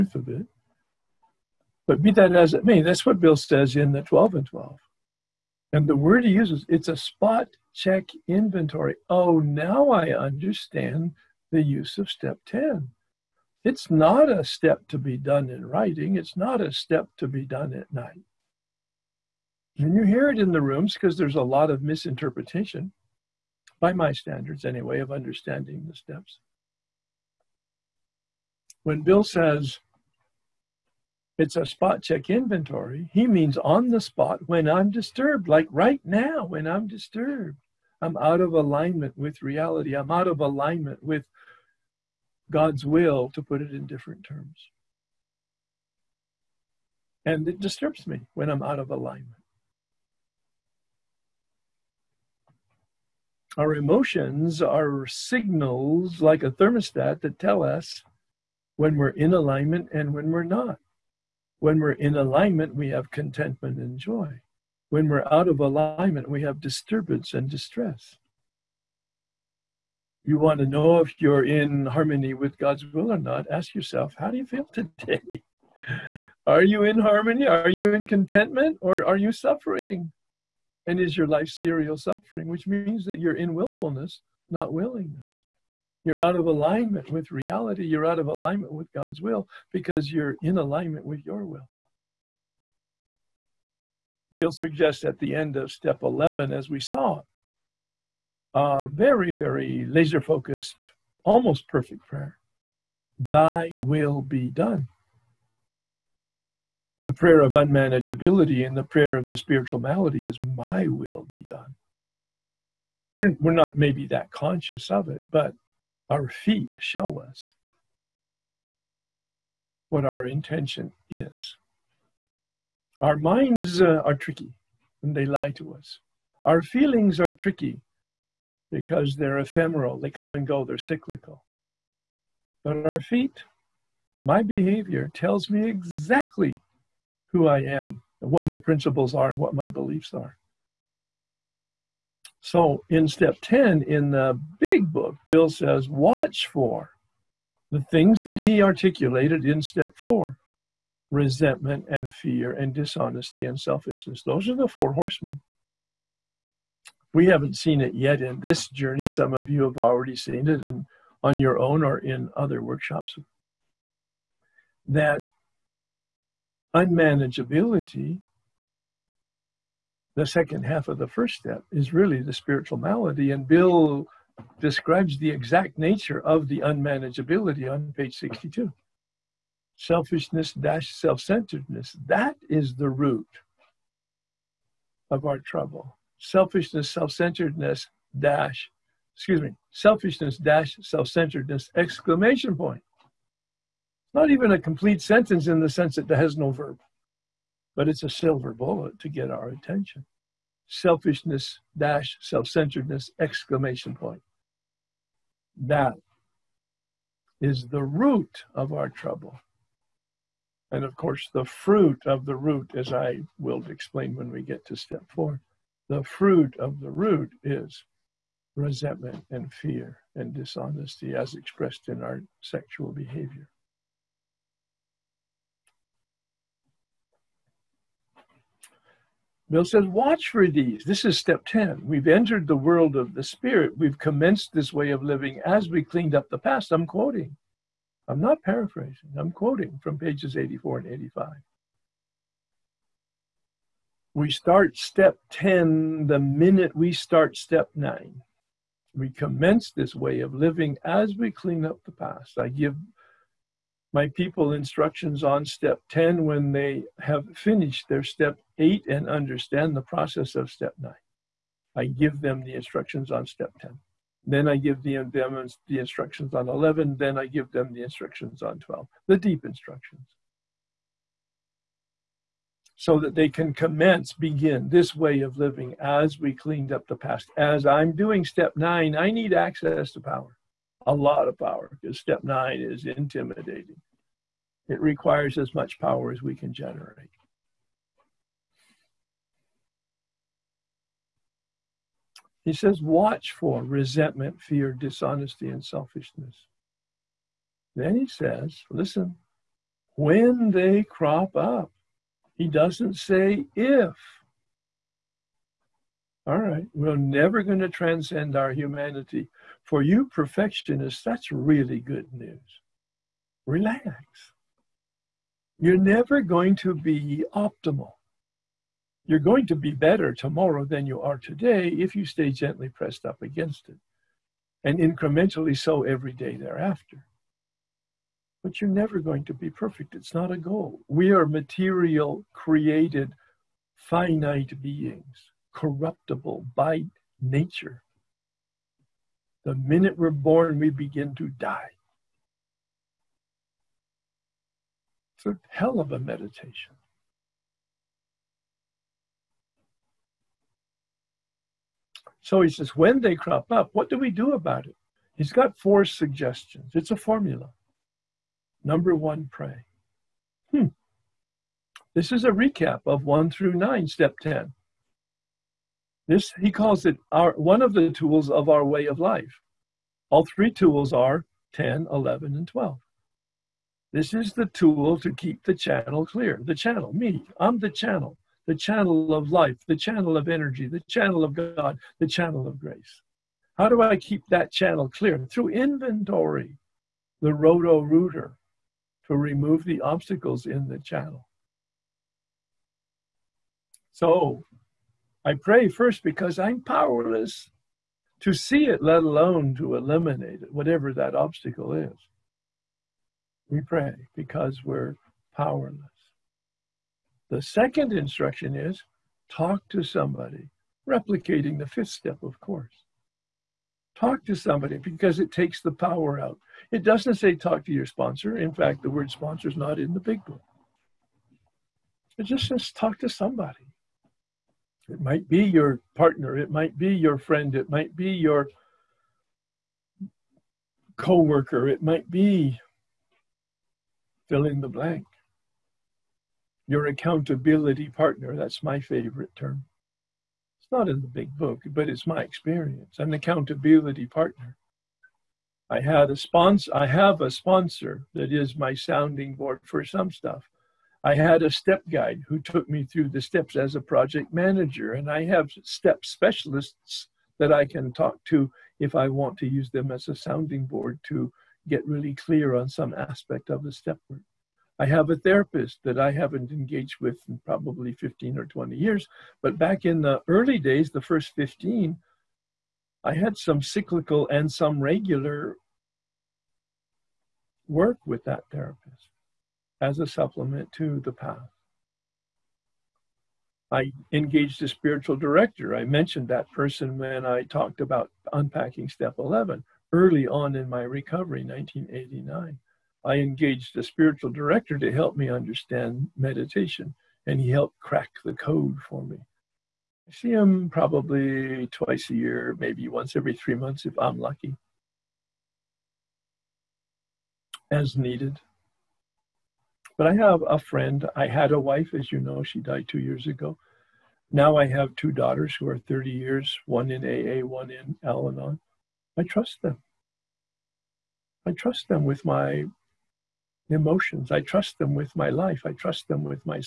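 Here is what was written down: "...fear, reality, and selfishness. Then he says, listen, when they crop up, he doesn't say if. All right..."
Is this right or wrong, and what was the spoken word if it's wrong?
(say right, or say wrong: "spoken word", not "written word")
wrong: "dishonesty", not "reality".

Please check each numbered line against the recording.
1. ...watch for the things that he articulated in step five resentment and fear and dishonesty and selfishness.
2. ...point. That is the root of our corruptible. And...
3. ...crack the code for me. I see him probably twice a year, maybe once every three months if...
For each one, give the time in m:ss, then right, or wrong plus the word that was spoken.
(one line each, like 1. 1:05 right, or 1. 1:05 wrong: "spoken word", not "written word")
1. 2:25 wrong: "four", not "five"
2. 3:23 wrong: "trouble", not "corruptible"
3. 8:17 right.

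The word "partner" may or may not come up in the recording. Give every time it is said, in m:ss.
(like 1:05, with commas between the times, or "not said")
7:05, 7:17, 7:24.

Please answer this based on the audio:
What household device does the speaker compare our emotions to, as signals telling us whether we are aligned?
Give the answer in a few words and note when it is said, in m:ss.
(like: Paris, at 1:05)
Thermostat, at 0:56.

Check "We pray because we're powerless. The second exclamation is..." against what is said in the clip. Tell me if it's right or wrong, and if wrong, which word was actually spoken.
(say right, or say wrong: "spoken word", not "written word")
wrong: "instruction", not "exclamation".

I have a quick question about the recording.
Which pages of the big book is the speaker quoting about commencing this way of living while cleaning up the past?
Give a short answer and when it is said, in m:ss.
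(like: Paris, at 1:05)
84 and 85, at 3:59.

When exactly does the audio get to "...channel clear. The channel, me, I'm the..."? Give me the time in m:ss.
6:15.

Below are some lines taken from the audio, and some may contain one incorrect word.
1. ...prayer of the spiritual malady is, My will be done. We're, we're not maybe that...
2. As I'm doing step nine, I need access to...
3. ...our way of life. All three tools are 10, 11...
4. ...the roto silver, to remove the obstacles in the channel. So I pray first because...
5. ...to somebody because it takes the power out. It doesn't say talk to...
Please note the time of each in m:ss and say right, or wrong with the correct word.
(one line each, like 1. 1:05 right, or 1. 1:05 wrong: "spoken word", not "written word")
1. 1:48 right
2. 4:37 right
3. 6:08 right
4. 6:27 wrong: "rooter", not "silver"
5. 6:54 right.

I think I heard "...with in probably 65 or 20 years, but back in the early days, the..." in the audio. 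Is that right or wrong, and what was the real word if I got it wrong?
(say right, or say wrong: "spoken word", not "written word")
wrong: "15", not "65".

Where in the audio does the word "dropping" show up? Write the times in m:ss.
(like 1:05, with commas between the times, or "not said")
not said.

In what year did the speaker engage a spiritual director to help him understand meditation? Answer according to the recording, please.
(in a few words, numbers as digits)
1989.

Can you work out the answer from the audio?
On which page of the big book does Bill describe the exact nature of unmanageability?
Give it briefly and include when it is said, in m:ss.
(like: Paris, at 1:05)
62, at 2:57.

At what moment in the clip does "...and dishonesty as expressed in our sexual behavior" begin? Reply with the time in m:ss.
3:40.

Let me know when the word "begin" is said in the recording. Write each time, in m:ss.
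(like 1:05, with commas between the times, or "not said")
4:34, 5:40.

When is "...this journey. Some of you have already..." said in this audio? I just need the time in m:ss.
2:38.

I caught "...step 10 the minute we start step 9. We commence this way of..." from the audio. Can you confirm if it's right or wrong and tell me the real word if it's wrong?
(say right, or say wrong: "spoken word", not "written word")
right.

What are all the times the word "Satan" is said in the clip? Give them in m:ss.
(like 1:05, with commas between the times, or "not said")
not said.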